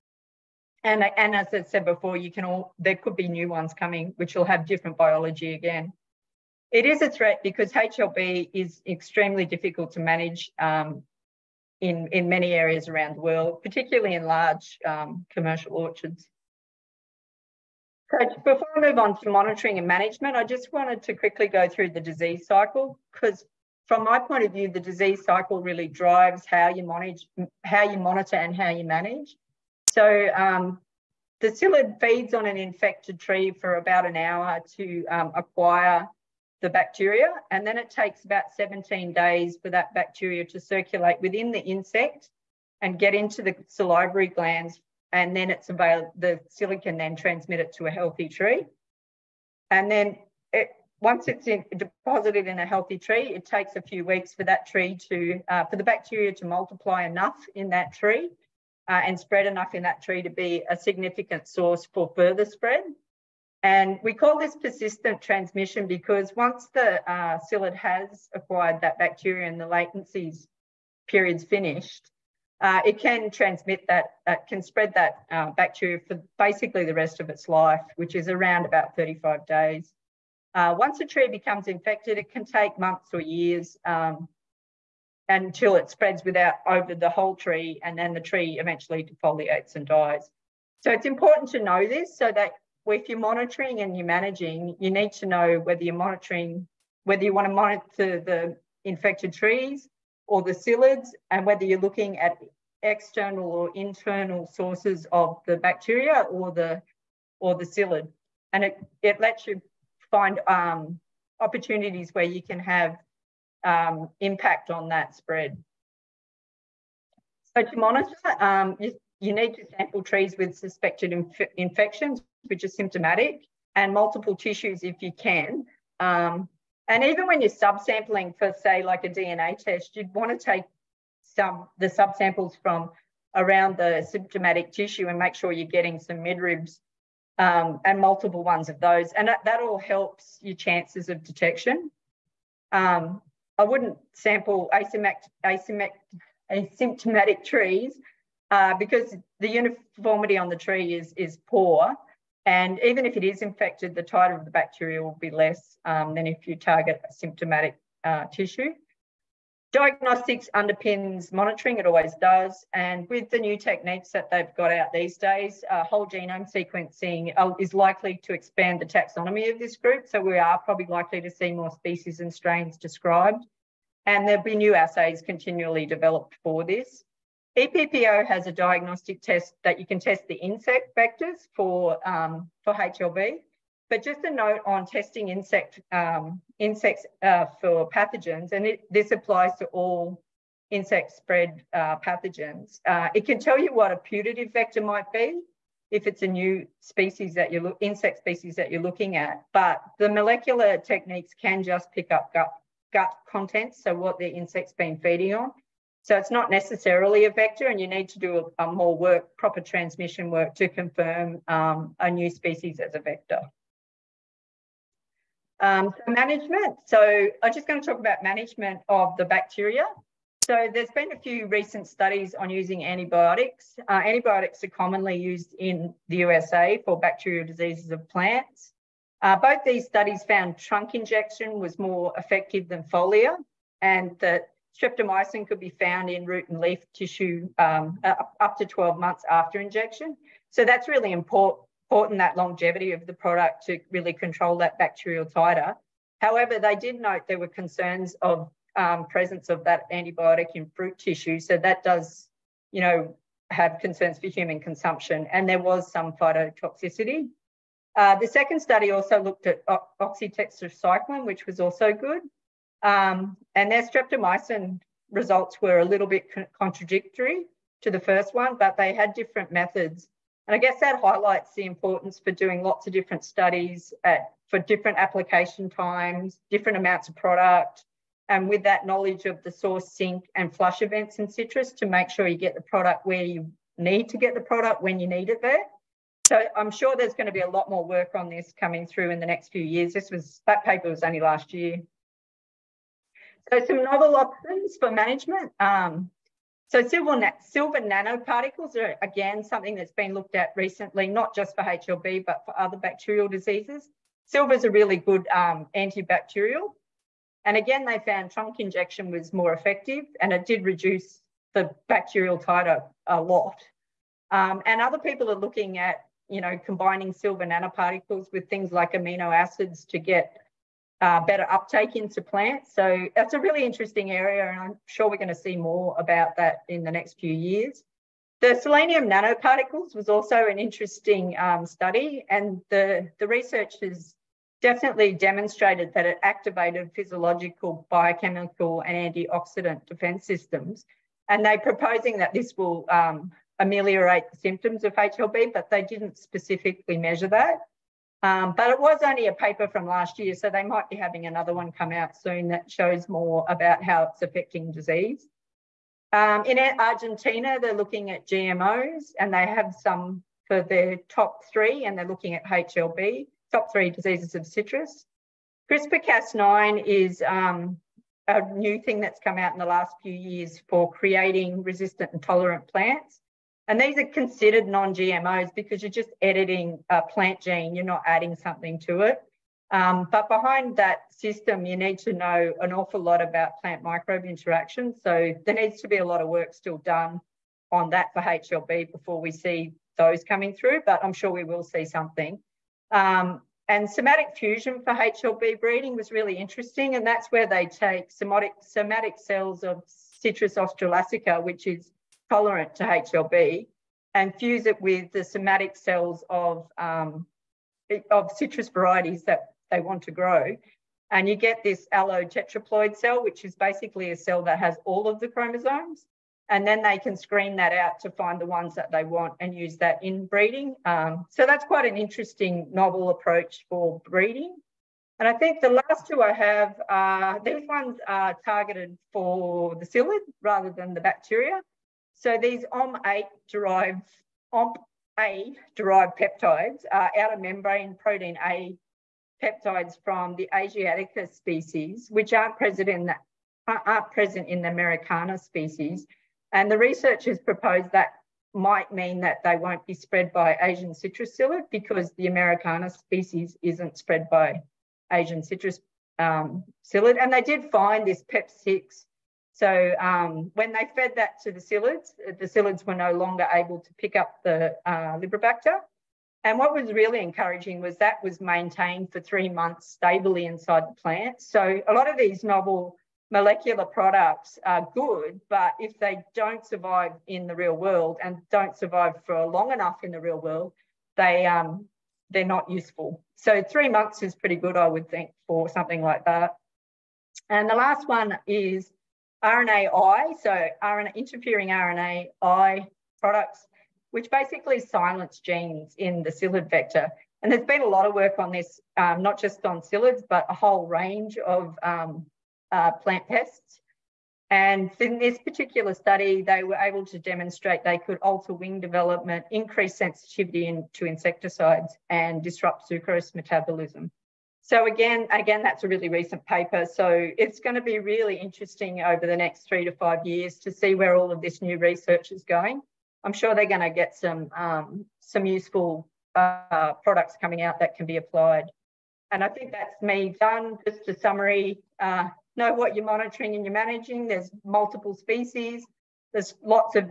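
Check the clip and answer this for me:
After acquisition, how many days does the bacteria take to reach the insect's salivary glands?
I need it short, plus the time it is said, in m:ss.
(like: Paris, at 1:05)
17 days, at 0:38.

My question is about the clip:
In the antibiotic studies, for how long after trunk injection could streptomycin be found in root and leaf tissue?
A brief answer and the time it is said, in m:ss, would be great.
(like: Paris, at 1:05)
12 months, at 3:58.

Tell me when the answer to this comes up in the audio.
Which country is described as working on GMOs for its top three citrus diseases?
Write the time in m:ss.
5:56.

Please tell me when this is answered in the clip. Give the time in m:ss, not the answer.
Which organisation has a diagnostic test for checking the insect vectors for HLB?
2:57.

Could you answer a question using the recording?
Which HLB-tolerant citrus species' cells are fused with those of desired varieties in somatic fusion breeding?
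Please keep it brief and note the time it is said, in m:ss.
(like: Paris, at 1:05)
Citrus australasica, at 6:39.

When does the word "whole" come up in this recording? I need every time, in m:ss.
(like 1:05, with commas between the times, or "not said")
1:27, 2:45, 8:20.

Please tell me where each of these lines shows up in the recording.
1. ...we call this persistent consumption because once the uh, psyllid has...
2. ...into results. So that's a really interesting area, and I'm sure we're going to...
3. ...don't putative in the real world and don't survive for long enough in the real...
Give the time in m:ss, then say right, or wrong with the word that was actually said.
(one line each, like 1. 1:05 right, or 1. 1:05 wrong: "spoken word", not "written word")
1. 1:04 wrong: "transmission", not "consumption"
2. 5:21 wrong: "plants", not "results"
3. 7:56 wrong: "survive", not "putative".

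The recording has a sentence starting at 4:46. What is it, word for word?
So I'm sure there's going to be a lot more work on this coming through in the next few years.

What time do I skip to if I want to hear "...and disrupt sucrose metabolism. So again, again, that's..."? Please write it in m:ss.
8:32.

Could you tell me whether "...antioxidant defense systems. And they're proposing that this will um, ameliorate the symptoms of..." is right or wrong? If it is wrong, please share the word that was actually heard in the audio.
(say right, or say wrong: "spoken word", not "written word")
right.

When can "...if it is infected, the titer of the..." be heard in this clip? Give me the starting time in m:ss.
2:33.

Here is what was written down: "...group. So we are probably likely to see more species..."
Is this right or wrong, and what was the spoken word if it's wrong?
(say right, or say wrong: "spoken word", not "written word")
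right.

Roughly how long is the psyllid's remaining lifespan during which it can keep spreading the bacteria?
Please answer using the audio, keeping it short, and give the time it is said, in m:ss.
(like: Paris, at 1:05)
35 days, at 1:18.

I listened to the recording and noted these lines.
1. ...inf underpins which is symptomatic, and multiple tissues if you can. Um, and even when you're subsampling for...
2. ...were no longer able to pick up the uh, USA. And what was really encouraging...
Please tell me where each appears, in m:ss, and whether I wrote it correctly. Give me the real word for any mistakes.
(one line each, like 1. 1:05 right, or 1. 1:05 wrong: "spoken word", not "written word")
1. 2:01 wrong: "infections", not "underpins"
2. 7:42 wrong: "Liberibacter", not "USA".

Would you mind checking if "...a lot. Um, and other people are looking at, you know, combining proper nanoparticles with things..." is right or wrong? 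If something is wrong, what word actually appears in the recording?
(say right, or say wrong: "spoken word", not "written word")
wrong: "silver", not "proper".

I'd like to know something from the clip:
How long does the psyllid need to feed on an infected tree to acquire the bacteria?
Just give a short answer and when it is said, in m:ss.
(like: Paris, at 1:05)
About an hour, at 0:33.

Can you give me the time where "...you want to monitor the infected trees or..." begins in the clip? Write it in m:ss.
1:37.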